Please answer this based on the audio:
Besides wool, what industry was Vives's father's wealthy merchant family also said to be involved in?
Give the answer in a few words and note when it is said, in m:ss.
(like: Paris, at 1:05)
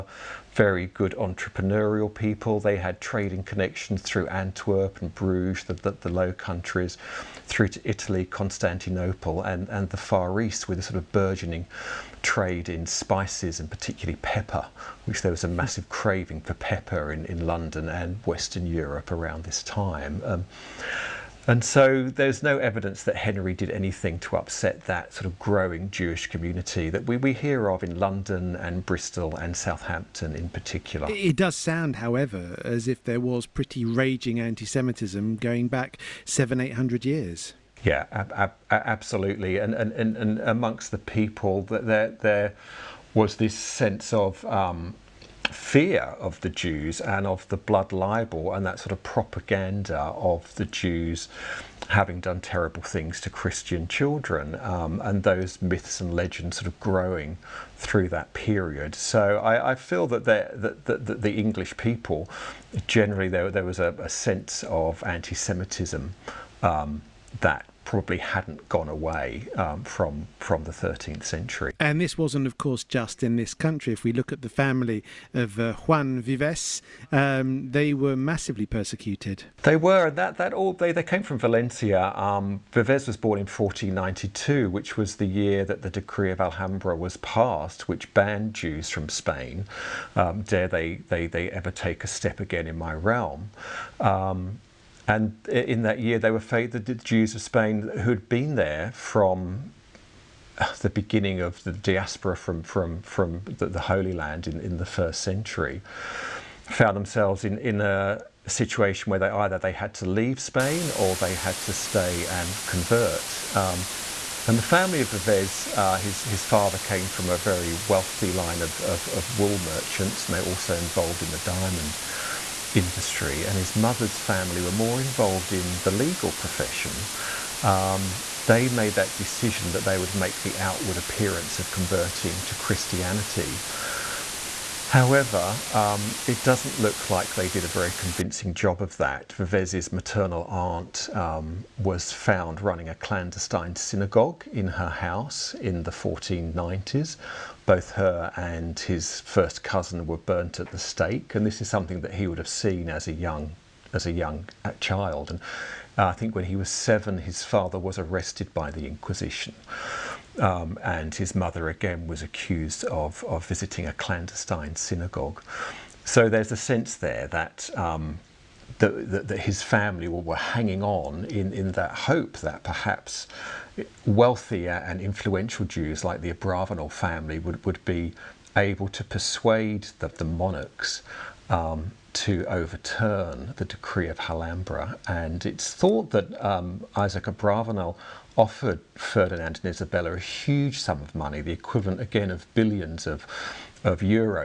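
Diamond industry, at 2:01.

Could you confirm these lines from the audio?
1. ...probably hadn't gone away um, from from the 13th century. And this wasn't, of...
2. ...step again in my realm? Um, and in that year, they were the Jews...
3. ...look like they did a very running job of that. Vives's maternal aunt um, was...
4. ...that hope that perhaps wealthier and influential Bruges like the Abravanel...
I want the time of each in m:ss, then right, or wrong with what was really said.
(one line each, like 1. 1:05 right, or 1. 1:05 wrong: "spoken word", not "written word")
1. 1:07 right
2. 1:32 right
3. 2:16 wrong: "convincing", not "running"
4. 2:51 wrong: "Jews", not "Bruges".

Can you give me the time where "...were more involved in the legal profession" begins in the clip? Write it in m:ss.
2:04.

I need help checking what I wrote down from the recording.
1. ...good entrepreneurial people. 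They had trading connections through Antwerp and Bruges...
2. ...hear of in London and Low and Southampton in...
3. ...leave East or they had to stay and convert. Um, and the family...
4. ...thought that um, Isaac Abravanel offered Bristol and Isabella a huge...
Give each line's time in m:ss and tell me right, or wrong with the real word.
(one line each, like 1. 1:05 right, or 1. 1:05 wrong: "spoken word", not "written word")
1. 0:00 right
2. 0:27 wrong: "Bristol", not "Low"
3. 1:50 wrong: "Spain", not "East"
4. 3:05 wrong: "Ferdinand", not "Bristol".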